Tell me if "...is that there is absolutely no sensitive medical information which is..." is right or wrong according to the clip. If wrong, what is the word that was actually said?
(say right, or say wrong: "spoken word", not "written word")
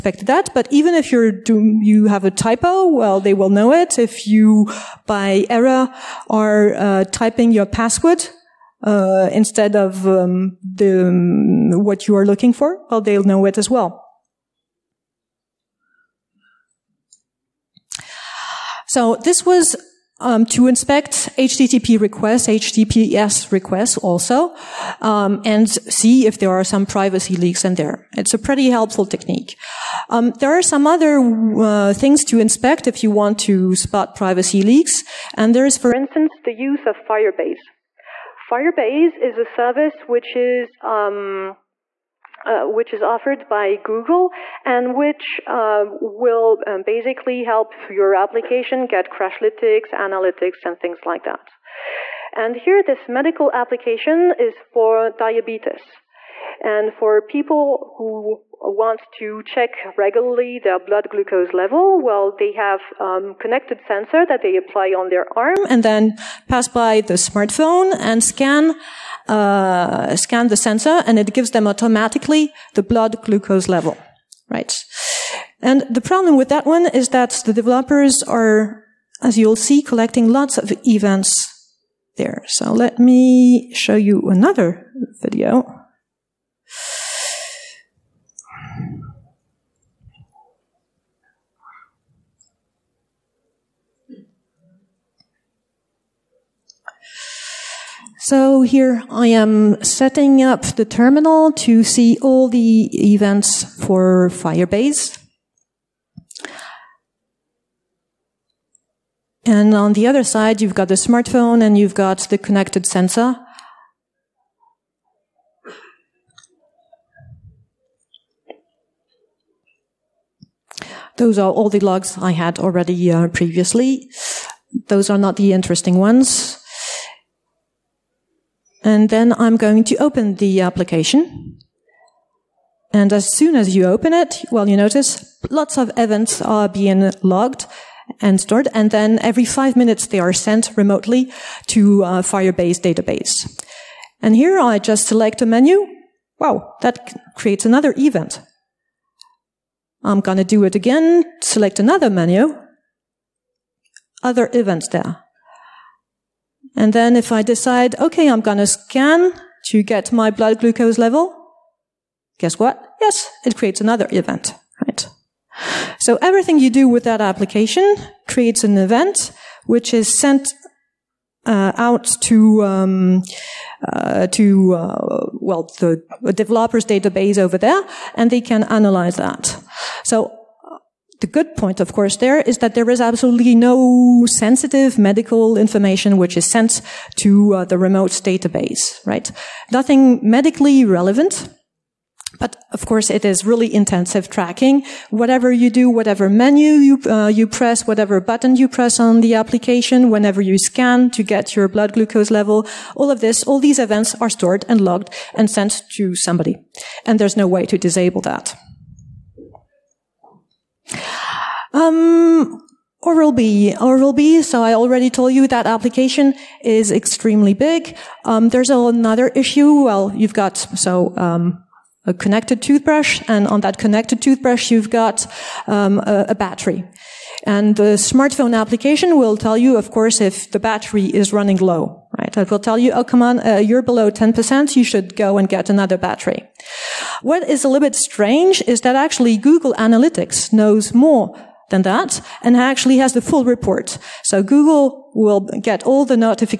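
right.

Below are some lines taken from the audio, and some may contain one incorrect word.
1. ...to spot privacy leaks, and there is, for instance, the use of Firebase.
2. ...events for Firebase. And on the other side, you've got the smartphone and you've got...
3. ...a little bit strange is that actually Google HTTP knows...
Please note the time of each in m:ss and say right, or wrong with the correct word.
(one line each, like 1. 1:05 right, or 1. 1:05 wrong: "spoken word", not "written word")
1. 0:33 right
2. 1:43 right
3. 3:57 wrong: "Analytics", not "HTTP".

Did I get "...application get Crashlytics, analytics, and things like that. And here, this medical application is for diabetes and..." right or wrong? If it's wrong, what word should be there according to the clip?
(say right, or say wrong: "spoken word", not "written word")
right.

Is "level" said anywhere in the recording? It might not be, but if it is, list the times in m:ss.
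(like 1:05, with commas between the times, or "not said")
1:01, 1:13, 2:40, 3:22.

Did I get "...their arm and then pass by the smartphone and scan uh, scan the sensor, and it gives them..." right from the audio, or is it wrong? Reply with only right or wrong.
right.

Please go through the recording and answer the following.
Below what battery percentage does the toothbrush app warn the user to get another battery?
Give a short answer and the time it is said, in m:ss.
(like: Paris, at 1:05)
10%, at 3:54.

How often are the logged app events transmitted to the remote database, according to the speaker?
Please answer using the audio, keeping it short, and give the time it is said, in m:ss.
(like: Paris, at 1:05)
Every 5 minutes, at 2:19.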